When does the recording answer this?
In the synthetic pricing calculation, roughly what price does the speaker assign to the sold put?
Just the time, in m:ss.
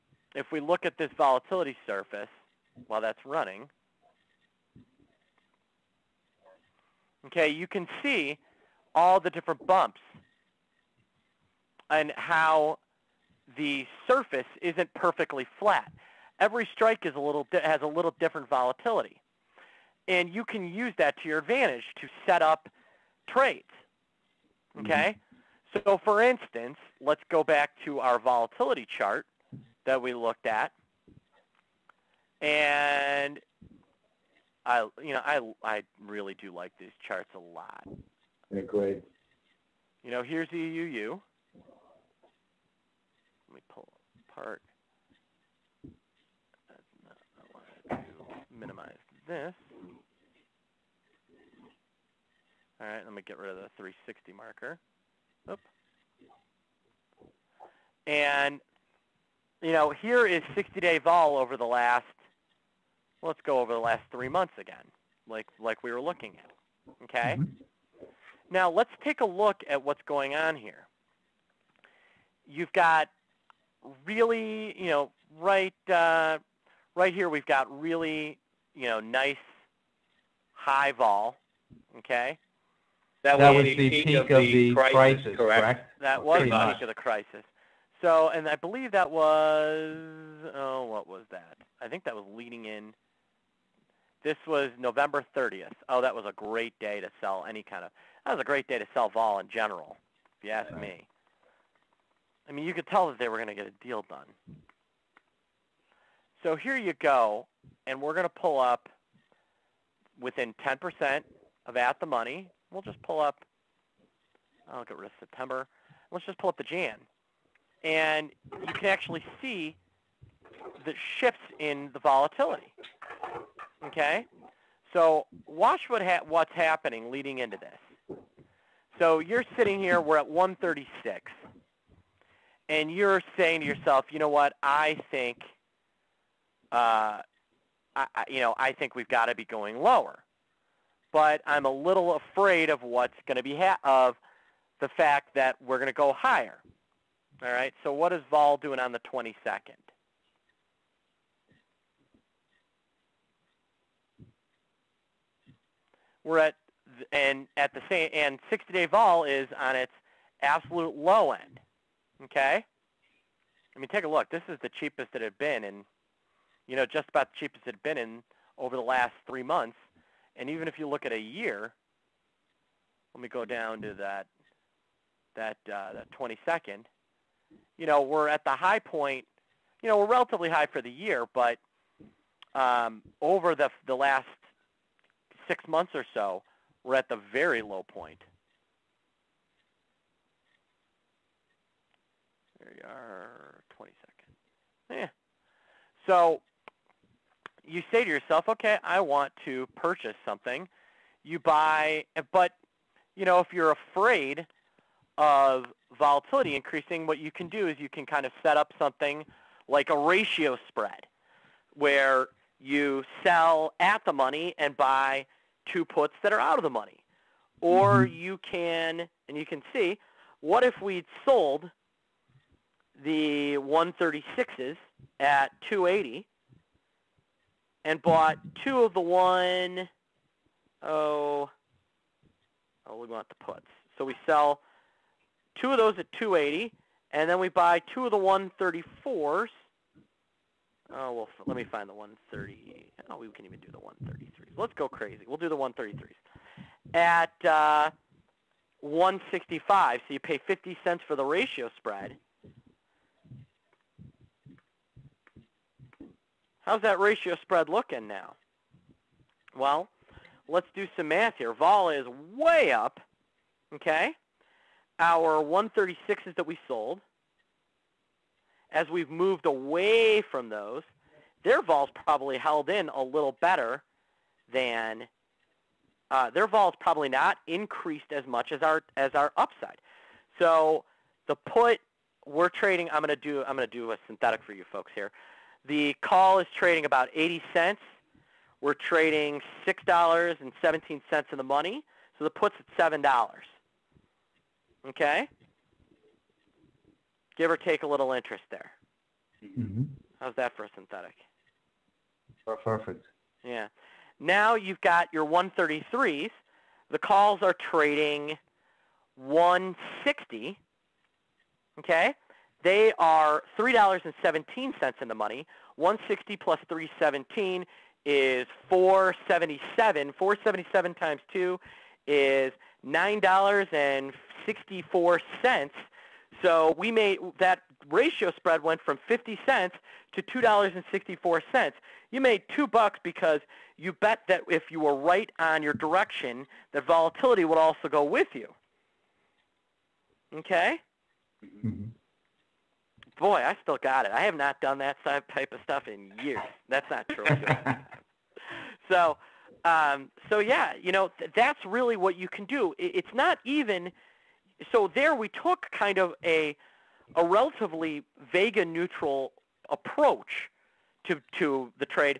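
4:52.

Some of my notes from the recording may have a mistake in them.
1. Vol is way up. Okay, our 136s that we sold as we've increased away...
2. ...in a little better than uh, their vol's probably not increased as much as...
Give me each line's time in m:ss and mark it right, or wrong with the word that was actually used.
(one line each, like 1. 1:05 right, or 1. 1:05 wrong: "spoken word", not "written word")
1. 4:21 wrong: "moved", not "increased"
2. 4:32 right.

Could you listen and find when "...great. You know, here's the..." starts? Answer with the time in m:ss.
0:38.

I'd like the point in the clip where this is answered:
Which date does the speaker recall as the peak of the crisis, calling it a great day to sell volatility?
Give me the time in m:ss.
1:34.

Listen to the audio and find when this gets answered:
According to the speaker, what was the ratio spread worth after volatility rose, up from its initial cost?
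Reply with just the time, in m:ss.
5:30.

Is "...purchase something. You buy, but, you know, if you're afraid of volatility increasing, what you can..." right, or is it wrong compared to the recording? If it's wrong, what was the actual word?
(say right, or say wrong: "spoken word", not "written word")
right.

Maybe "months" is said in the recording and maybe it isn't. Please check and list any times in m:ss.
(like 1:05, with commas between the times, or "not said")
1:04, 2:49, 3:05.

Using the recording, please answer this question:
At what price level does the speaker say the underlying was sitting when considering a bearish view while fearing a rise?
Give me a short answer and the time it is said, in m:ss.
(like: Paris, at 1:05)
136, at 2:10.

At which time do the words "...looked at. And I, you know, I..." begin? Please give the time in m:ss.
0:30.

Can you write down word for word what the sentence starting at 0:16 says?
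Every strike is a little has a little different volatility.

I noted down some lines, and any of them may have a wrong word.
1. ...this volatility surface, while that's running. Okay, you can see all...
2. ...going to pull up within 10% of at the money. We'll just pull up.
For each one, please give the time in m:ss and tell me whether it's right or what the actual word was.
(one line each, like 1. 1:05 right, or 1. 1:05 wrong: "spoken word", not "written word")
1. 0:00 right
2. 1:48 right.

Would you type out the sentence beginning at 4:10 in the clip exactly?
So you pay 50 cents for the ratio spread.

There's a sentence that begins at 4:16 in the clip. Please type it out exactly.
How's that ratio spread looking now?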